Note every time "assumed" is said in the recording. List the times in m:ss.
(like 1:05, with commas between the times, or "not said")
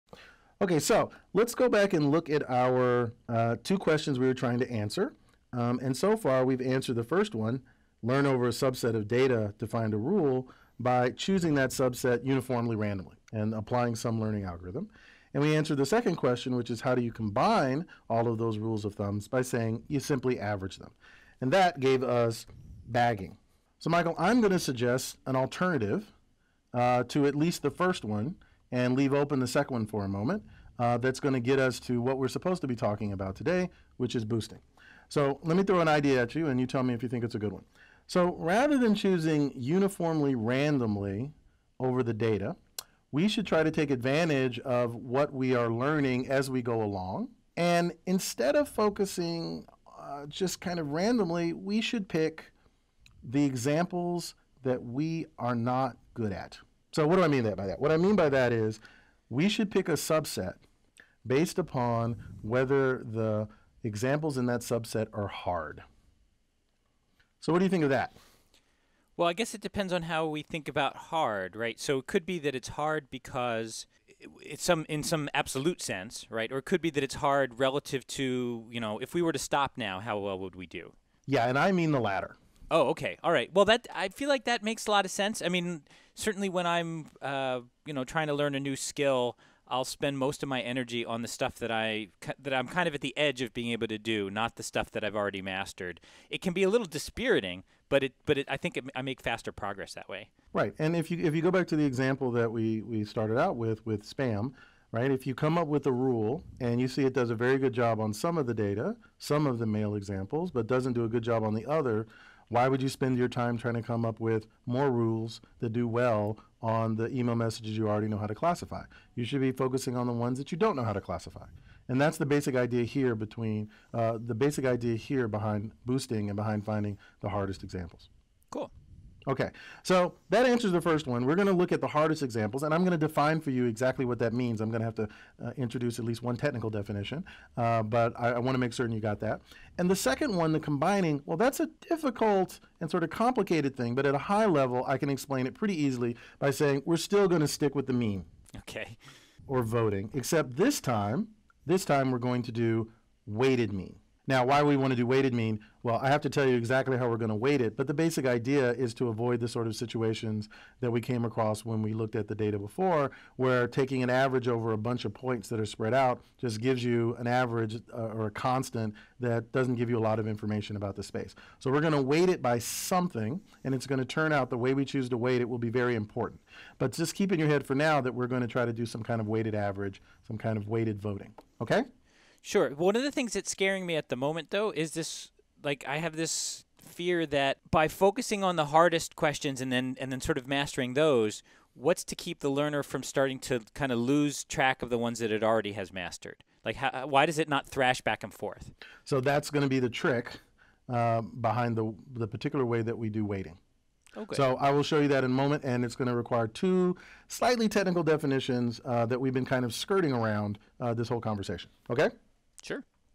not said.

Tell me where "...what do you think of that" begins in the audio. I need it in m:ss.
1:07.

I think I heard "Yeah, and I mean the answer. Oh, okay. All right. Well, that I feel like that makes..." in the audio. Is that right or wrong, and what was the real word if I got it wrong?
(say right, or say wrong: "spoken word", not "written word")
wrong: "latter", not "answer".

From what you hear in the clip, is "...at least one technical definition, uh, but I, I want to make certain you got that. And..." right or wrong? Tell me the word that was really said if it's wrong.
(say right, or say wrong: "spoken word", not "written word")
right.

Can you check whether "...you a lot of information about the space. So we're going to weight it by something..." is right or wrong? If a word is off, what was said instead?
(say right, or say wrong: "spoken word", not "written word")
right.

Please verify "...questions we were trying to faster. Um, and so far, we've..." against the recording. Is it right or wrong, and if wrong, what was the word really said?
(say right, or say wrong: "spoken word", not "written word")
wrong: "answer", not "faster".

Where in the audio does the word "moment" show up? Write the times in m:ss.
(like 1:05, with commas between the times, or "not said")
0:30, 3:04, 3:25.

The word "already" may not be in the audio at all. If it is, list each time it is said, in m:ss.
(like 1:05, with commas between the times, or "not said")
1:35, 1:57, 3:15.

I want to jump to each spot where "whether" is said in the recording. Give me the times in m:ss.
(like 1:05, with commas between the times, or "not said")
1:02.